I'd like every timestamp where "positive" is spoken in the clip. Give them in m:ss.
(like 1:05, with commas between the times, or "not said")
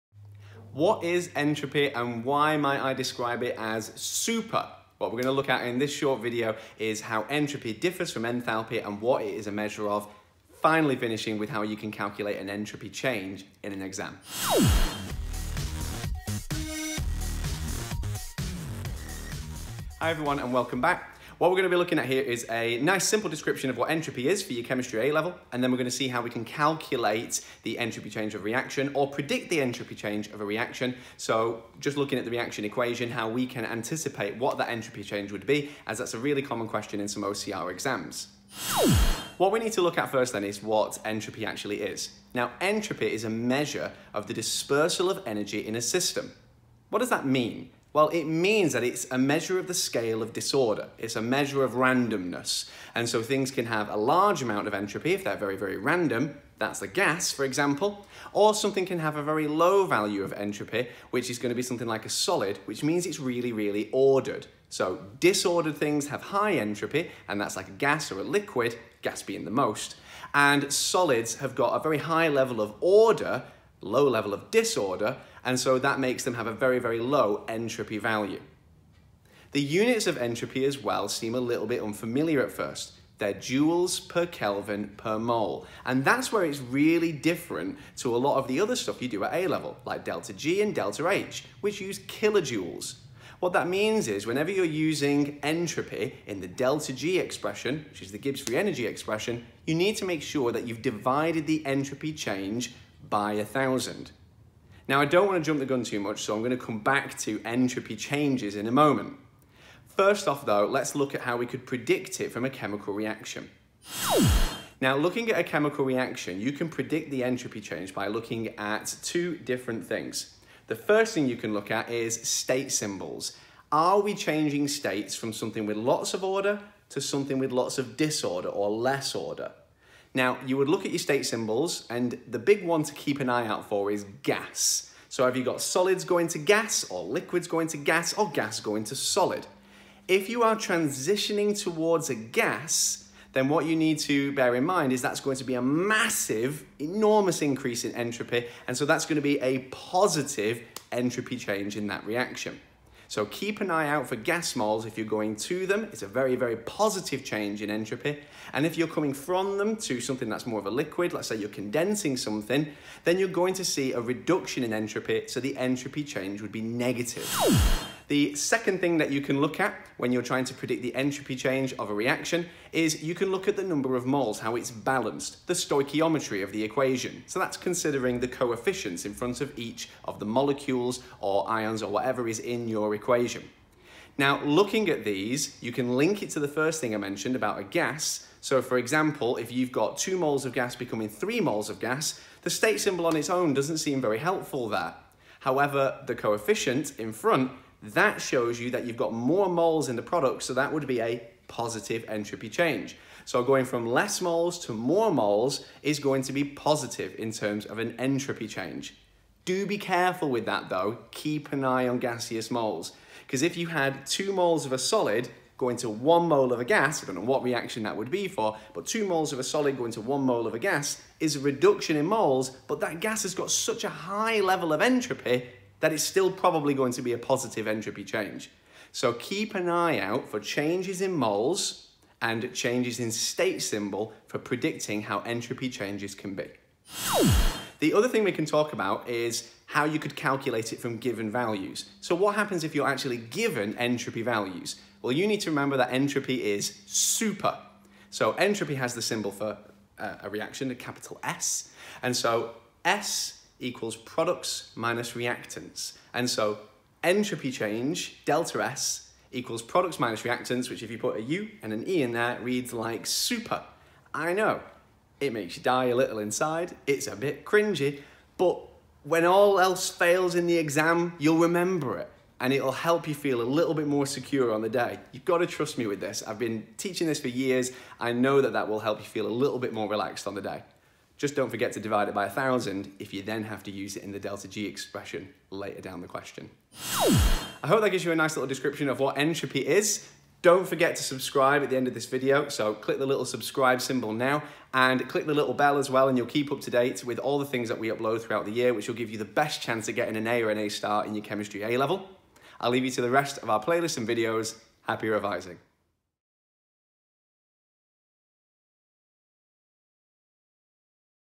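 2:29, 2:36, 3:21, 3:26, 3:47.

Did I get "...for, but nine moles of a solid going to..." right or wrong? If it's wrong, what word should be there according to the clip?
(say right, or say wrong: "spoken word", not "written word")
wrong: "two", not "nine".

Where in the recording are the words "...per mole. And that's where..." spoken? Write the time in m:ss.
1:24.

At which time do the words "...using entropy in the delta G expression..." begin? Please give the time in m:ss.
1:34.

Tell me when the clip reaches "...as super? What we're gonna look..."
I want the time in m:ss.
0:03.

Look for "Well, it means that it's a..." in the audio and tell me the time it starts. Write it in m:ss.
0:47.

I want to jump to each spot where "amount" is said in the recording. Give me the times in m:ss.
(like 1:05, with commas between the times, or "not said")
0:54.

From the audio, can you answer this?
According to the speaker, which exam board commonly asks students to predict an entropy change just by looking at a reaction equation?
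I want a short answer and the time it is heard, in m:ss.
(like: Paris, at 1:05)
OCR, at 0:37.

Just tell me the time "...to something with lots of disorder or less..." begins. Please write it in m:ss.
2:06.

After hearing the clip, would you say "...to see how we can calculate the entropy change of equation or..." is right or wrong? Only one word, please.
wrong.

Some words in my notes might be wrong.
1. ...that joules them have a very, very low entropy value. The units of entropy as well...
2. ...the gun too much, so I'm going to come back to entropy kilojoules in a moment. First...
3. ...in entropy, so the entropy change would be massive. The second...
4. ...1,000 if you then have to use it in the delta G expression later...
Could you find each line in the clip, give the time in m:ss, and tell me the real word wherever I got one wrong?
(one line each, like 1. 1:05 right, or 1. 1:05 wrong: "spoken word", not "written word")
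1. 1:15 wrong: "makes", not "joules"
2. 1:45 wrong: "changes", not "kilojoules"
3. 2:44 wrong: "negative", not "massive"
4. 4:42 right.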